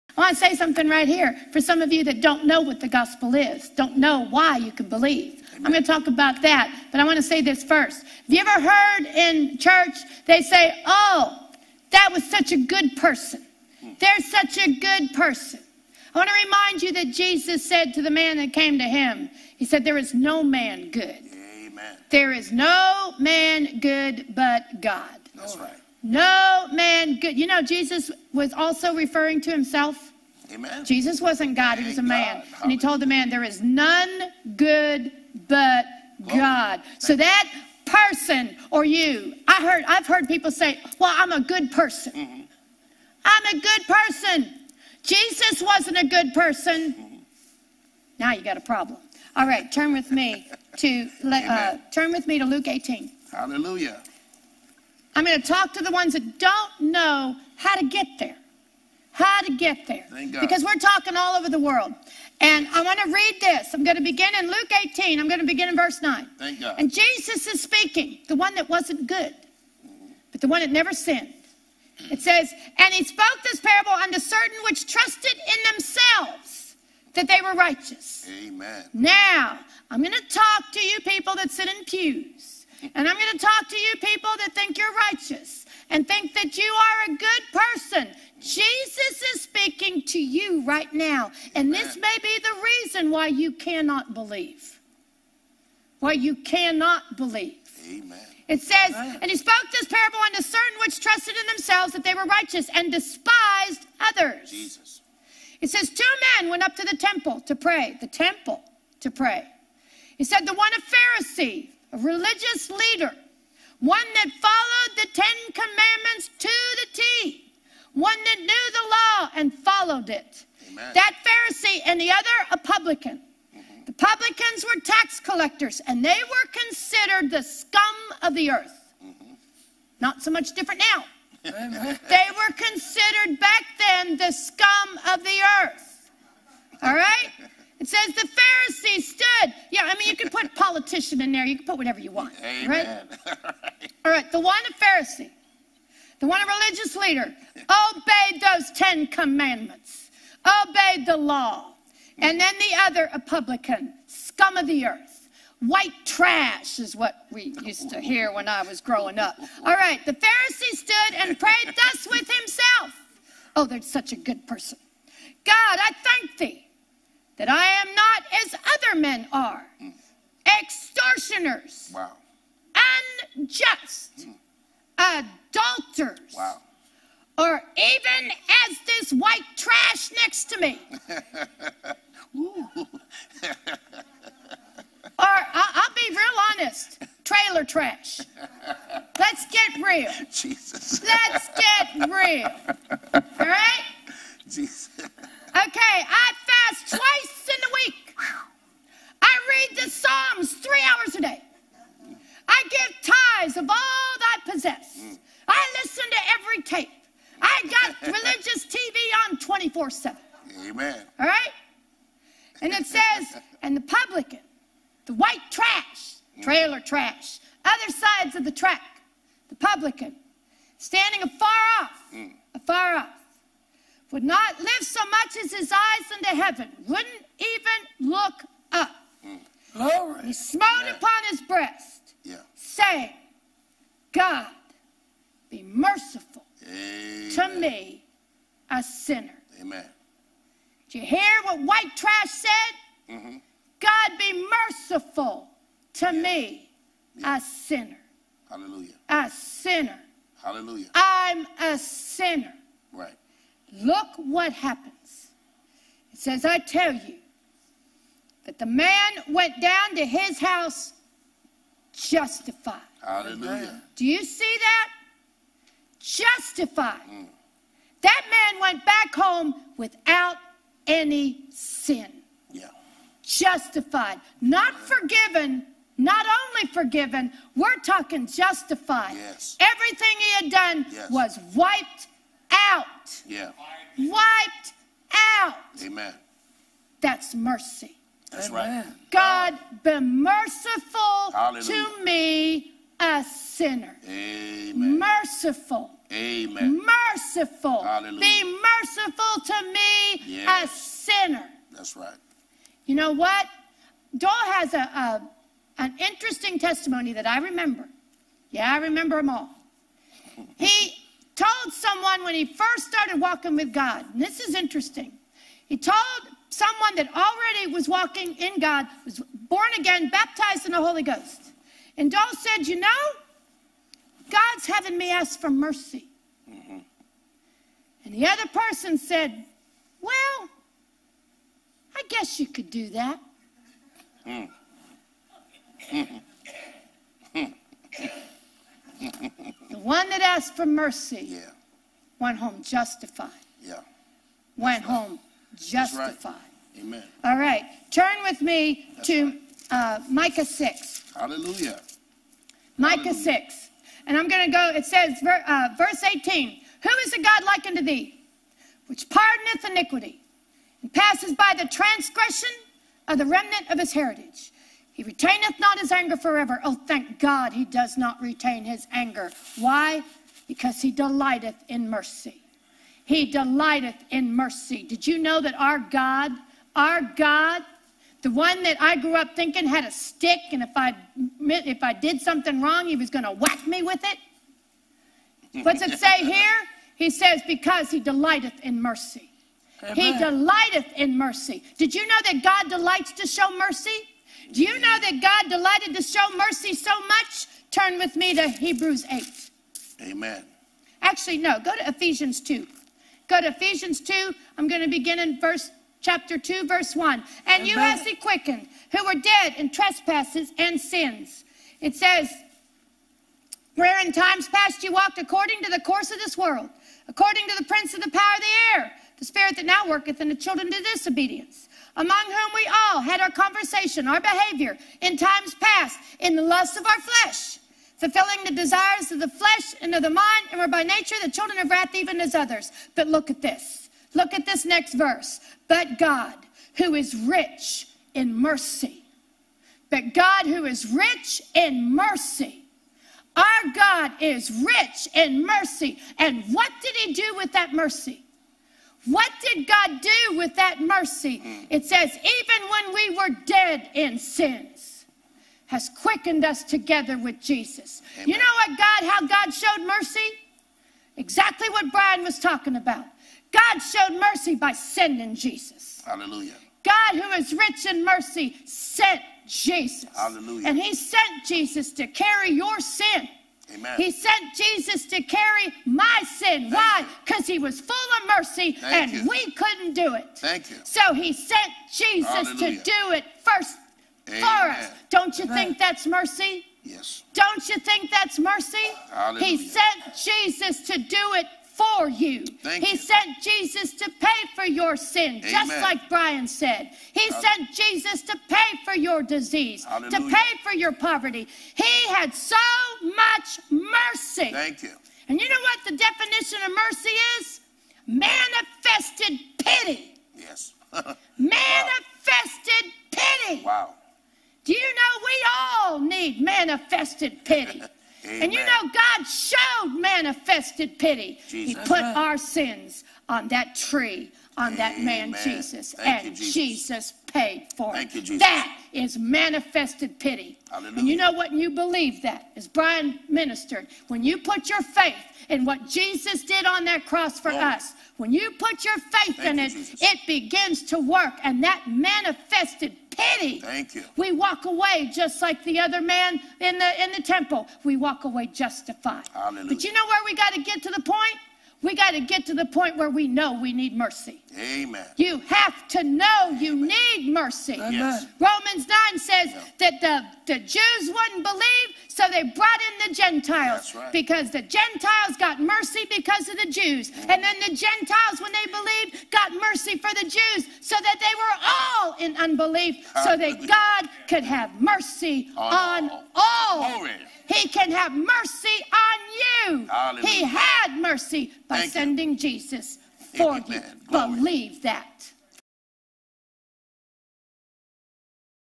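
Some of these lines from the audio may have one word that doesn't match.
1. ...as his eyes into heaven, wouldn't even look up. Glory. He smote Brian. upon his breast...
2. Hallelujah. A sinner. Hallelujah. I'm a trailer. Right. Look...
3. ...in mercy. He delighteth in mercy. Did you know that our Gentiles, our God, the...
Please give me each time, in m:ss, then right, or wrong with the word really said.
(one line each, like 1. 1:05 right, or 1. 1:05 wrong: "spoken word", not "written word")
1. 3:45 wrong: "Amen", not "Brian"
2. 4:08 wrong: "sinner", not "trailer"
3. 6:11 wrong: "God", not "Gentiles".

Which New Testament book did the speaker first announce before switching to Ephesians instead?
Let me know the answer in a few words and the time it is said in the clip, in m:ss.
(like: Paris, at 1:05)
Hebrews, at 6:38.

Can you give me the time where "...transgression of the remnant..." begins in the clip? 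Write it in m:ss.
6:01.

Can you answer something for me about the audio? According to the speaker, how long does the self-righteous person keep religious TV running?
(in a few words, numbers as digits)
24 7.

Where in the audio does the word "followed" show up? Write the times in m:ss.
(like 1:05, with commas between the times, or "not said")
1:54, 1:59.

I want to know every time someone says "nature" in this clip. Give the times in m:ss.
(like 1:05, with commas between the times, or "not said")
7:10.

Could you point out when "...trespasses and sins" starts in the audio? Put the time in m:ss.
6:49.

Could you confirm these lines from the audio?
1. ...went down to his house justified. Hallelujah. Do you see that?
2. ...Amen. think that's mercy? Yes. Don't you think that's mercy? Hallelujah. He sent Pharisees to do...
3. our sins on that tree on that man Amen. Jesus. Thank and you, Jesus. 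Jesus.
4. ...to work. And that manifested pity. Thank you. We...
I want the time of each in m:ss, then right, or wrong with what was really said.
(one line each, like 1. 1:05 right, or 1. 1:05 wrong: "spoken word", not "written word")
1. 4:19 right
2. 8:05 wrong: "Jesus", not "Pharisees"
3. 8:42 right
4. 9:00 right.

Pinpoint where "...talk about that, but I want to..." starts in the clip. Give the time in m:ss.
0:05.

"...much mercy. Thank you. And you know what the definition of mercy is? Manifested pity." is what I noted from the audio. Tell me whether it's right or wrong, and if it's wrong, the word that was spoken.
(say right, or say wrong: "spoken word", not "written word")
right.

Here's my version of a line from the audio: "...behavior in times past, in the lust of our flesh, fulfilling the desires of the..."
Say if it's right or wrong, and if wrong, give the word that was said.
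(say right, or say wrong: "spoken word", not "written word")
right.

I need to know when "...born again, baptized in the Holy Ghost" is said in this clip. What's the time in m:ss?
5:19.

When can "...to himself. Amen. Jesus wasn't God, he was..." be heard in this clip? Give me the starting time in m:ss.
0:29.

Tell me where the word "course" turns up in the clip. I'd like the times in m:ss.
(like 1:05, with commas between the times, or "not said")
6:55.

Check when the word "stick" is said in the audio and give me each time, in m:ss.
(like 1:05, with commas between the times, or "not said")
6:19.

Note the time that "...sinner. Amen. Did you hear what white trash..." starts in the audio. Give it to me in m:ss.
3:58.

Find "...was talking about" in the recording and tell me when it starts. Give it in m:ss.
7:42.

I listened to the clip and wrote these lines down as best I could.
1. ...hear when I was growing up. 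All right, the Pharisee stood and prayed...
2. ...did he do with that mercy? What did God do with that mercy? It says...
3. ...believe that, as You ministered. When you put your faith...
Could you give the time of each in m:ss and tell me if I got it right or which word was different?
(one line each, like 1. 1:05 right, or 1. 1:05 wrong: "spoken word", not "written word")
1. 2:37 right
2. 7:26 right
3. 8:51 wrong: "Brian", not "You".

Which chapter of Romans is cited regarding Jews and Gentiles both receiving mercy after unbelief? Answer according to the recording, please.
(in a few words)
Romans 9.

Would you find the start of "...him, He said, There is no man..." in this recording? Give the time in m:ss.
0:18.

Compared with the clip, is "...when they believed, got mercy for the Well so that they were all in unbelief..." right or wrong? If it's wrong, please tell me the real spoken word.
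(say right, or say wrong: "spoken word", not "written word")
wrong: "Jews", not "Well".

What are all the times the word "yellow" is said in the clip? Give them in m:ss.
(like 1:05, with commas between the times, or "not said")
not said.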